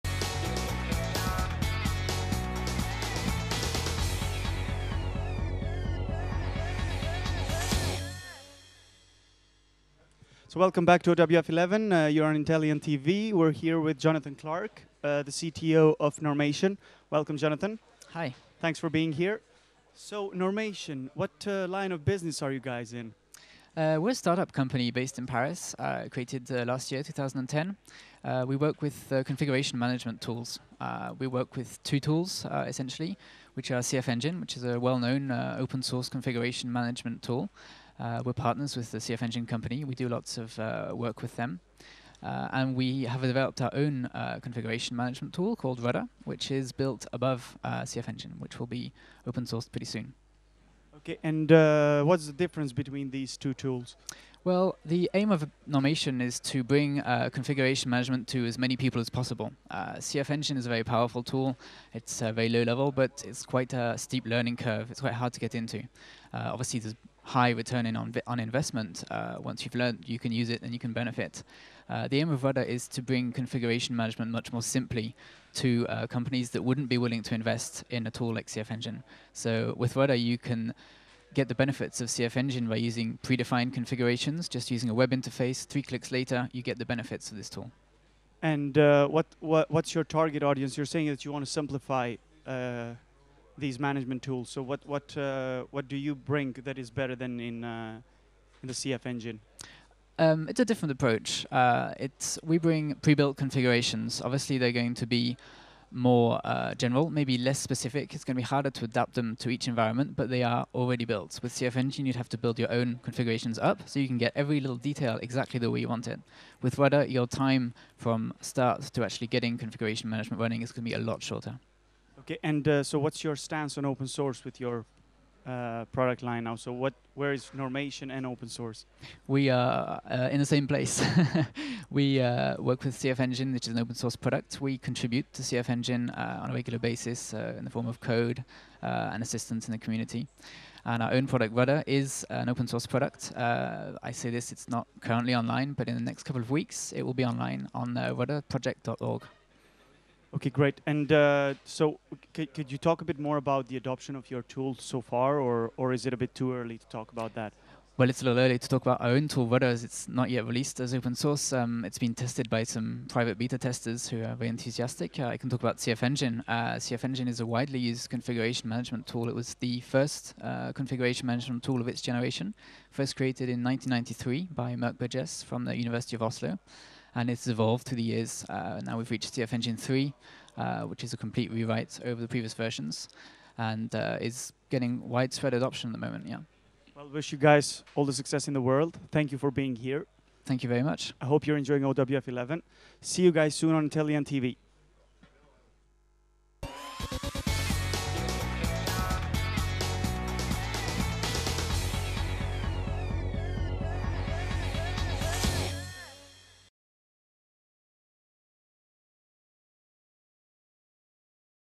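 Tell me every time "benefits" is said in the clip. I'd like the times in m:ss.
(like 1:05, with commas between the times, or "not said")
1:10, 1:21, 1:26.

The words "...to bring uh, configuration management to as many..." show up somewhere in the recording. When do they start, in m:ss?
0:56.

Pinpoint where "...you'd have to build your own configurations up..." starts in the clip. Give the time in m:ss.
1:52.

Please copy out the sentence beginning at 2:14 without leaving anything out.
We contribute to CF Engine uh, on a regular basis uh, in the form of code uh, and assistance in the community.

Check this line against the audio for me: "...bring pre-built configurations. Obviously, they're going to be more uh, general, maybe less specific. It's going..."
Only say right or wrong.
right.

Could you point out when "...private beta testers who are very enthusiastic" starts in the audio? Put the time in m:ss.
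2:43.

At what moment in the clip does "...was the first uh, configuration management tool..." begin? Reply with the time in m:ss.
2:49.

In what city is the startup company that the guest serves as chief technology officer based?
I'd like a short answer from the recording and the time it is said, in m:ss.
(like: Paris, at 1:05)
Paris, at 0:25.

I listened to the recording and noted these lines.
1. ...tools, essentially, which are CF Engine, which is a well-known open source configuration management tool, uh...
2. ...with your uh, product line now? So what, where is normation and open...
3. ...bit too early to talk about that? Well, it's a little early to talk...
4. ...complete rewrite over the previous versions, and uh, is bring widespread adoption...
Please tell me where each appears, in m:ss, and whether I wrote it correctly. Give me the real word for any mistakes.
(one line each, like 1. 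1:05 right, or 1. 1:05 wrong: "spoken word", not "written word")
1. 0:32 right
2. 2:04 right
3. 2:36 right
4. 3:01 wrong: "getting", not "bring".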